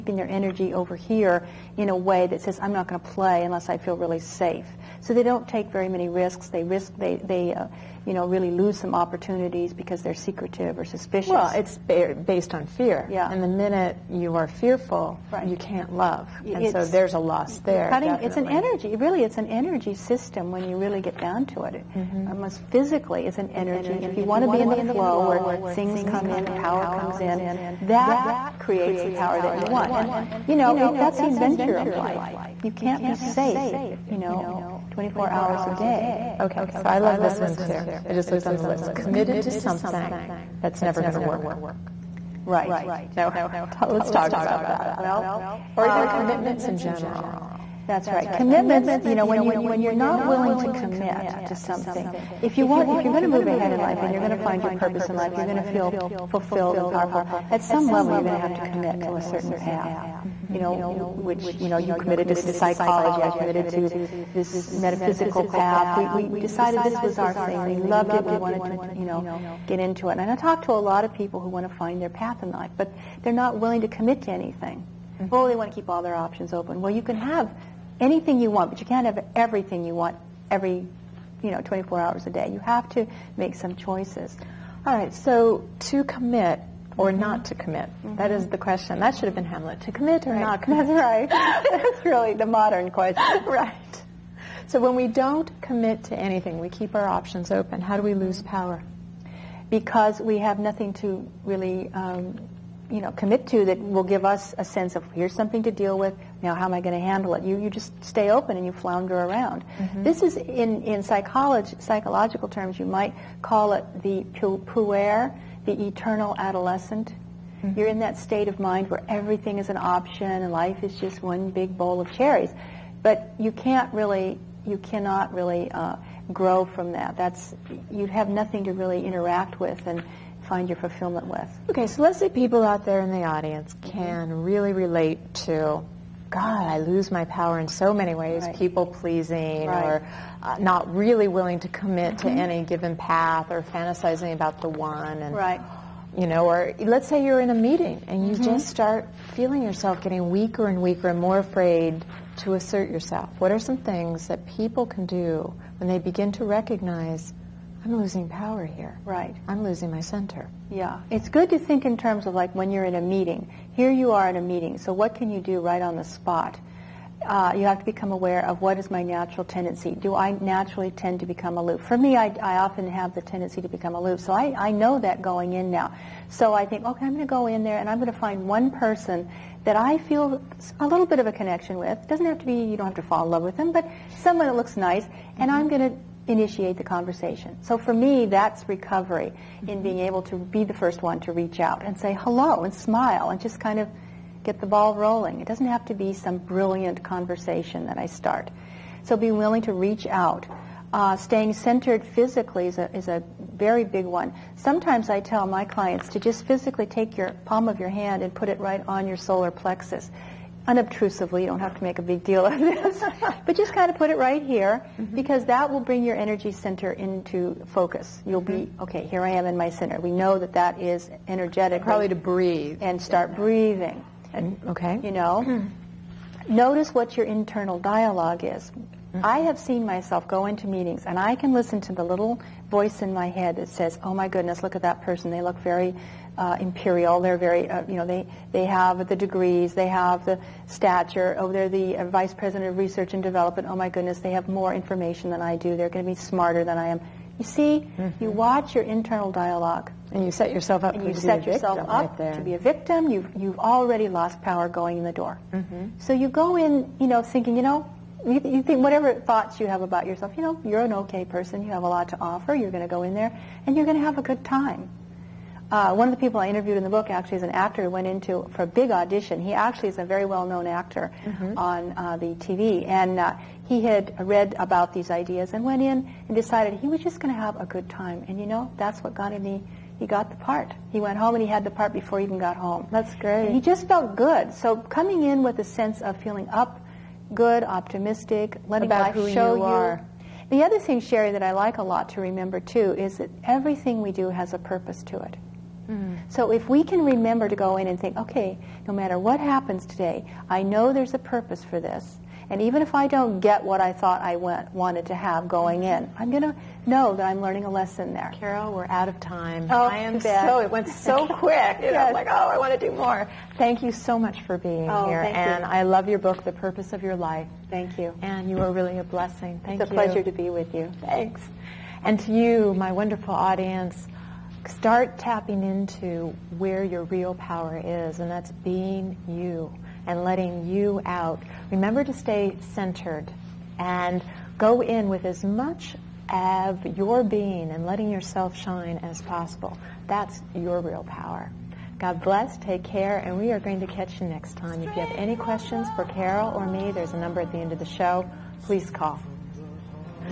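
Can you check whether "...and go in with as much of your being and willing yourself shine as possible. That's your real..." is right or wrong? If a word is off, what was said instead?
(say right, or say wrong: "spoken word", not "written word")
wrong: "letting", not "willing".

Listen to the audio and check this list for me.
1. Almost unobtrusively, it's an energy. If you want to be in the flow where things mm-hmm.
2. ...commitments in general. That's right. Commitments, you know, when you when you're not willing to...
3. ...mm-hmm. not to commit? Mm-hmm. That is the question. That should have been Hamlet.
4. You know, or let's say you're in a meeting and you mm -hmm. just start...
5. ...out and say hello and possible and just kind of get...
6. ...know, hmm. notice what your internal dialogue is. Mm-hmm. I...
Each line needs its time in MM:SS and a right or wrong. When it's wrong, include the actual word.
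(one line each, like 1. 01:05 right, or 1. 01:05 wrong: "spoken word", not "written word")
1. 00:22 wrong: "physically", not "unobtrusively"
2. 00:46 right
3. 01:27 right
4. 02:26 right
5. 03:11 wrong: "smile", not "possible"
6. 03:45 right.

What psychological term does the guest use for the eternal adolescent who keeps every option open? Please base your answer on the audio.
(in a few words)
the puer.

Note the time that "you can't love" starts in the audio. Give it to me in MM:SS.
00:15.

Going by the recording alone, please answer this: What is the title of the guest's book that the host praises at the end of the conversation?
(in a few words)
The Purpose of Your Life.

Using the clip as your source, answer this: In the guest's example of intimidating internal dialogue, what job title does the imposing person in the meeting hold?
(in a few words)
vice president of research and development.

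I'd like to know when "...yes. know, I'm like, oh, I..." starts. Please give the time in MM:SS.
05:11.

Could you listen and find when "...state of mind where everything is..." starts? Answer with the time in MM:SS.
01:58.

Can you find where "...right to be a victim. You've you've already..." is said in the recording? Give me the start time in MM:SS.
04:12.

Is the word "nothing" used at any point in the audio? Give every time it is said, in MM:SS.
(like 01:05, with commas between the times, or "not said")
01:40, 02:08.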